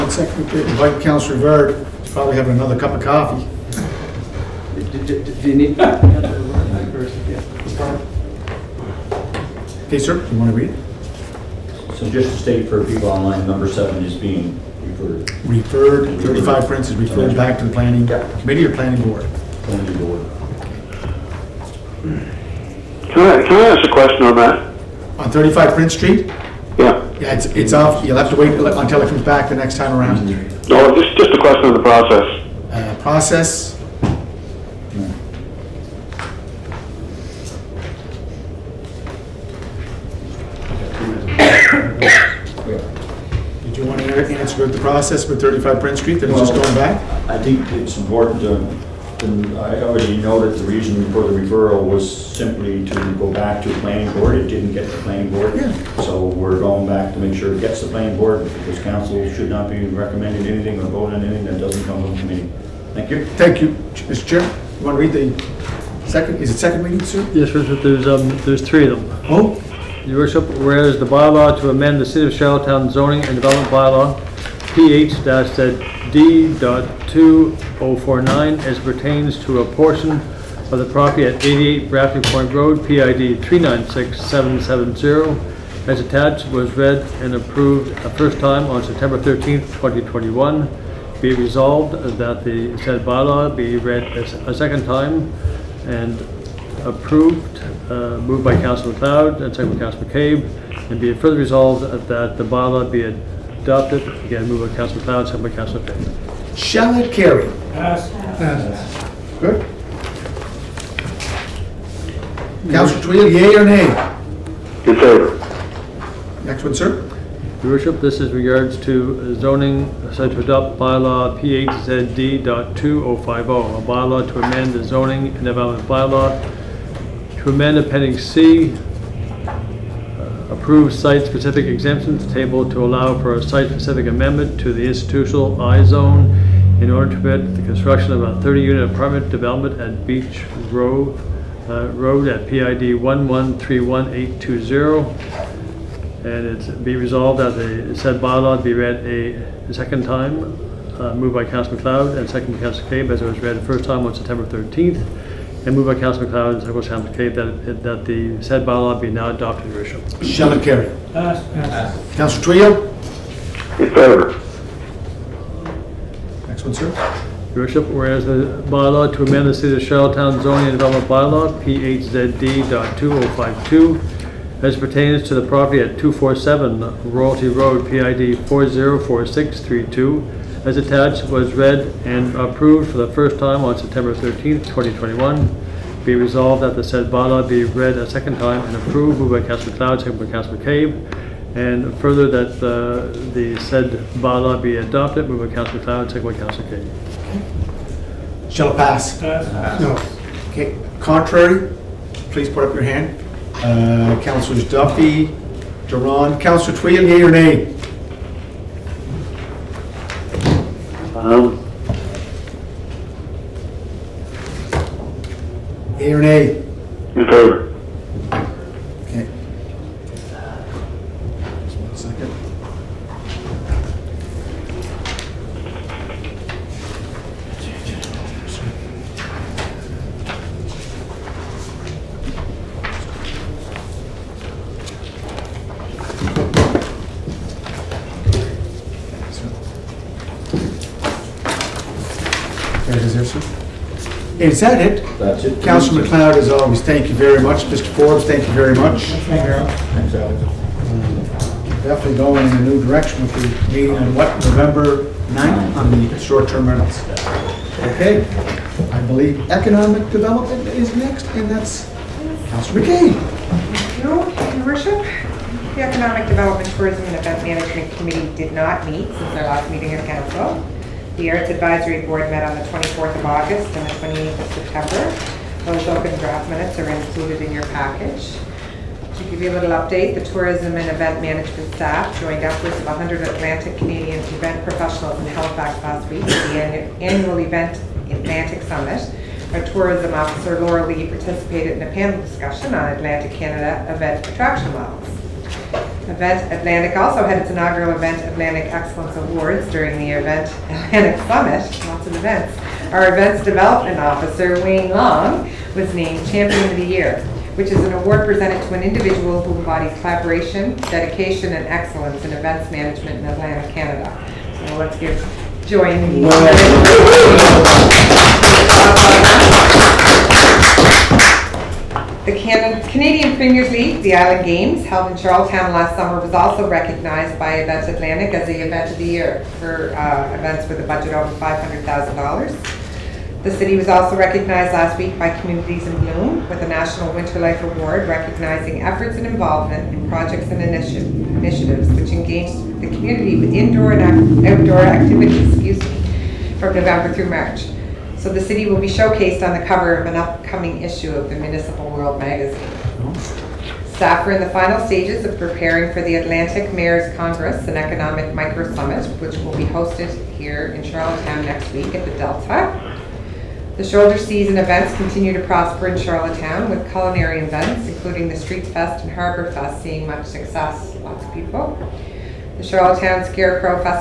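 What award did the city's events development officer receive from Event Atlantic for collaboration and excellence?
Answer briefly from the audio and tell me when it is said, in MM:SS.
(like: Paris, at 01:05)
Champion of the Year, at 05:06.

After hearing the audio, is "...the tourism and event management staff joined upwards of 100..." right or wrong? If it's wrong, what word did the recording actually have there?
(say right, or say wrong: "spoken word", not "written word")
right.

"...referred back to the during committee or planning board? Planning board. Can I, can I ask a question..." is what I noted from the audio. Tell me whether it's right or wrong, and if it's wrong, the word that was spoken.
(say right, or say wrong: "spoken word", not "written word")
wrong: "planning", not "during".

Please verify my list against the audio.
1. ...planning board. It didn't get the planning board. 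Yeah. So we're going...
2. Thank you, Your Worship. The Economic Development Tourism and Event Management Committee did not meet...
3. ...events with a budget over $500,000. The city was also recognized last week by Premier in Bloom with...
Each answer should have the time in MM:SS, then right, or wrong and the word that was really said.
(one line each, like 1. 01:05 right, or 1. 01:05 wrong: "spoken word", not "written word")
1. 00:53 right
2. 04:23 right
3. 05:30 wrong: "Communities", not "Premier".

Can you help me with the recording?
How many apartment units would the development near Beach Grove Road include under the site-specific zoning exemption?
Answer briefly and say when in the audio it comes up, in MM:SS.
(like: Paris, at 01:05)
30, at 02:18.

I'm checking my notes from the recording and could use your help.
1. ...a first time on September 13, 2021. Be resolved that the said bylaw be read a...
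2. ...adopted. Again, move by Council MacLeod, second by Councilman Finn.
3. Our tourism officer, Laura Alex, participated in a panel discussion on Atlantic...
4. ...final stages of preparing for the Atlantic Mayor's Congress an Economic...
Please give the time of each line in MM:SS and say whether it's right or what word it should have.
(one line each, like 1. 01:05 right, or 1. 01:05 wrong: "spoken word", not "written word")
1. 01:28 right
2. 01:43 right
3. 04:49 wrong: "Lee", not "Alex"
4. 05:54 right.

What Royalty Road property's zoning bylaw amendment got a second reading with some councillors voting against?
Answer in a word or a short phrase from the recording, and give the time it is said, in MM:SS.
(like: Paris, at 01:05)
247 Royalty Road, at 02:55.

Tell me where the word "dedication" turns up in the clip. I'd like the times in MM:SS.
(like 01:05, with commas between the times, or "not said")
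05:10.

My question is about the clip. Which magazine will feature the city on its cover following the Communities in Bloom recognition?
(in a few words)
Municipal World.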